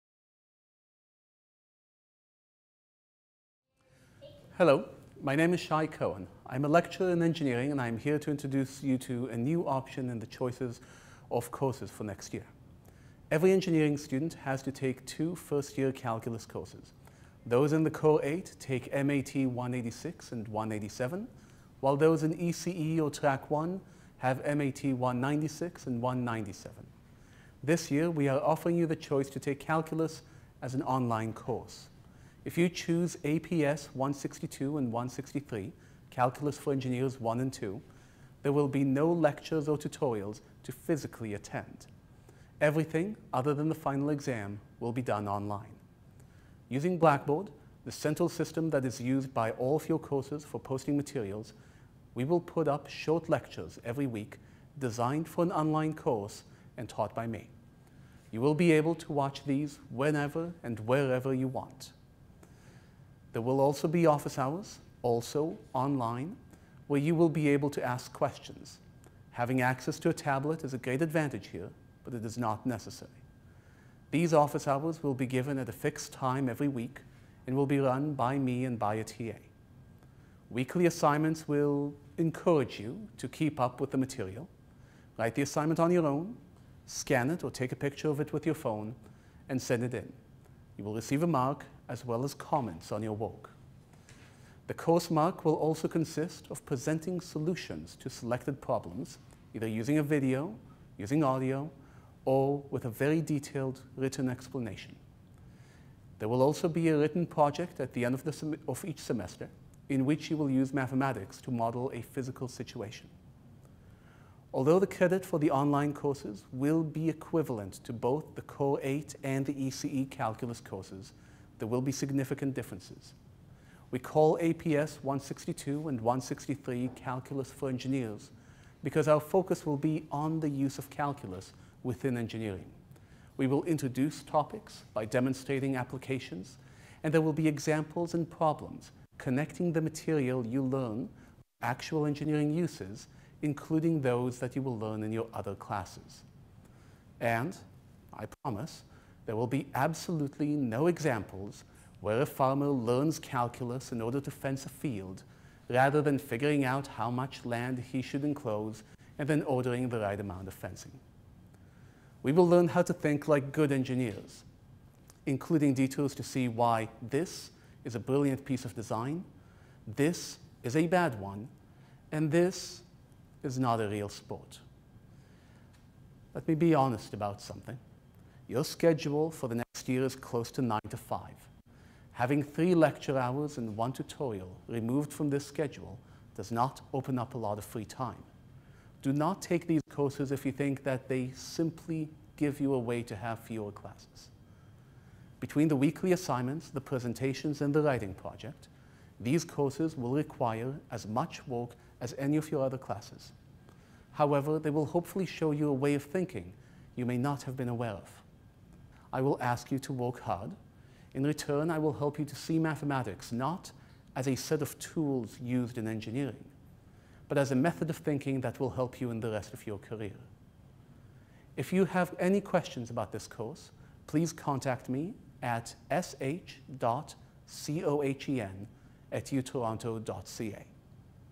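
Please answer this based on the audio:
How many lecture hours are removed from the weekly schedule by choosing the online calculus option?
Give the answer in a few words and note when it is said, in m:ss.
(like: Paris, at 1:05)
3, at 3:02.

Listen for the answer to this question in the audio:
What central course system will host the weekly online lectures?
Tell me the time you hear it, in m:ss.
0:46.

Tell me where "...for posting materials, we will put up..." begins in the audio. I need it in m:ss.
0:50.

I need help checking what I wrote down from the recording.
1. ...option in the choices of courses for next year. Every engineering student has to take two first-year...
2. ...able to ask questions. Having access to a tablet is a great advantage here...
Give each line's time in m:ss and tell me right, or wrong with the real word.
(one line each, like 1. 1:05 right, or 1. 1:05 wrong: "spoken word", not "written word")
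1. 0:09 right
2. 1:07 right.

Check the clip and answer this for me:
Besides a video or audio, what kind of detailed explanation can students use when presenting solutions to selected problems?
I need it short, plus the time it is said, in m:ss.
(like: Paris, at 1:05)
Written explanation, at 1:43.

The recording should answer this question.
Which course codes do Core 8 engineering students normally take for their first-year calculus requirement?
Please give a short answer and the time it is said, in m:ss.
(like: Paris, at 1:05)
MAT 186 and 187, at 0:18.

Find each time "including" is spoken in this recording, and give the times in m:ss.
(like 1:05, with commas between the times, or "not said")
2:23, 2:45.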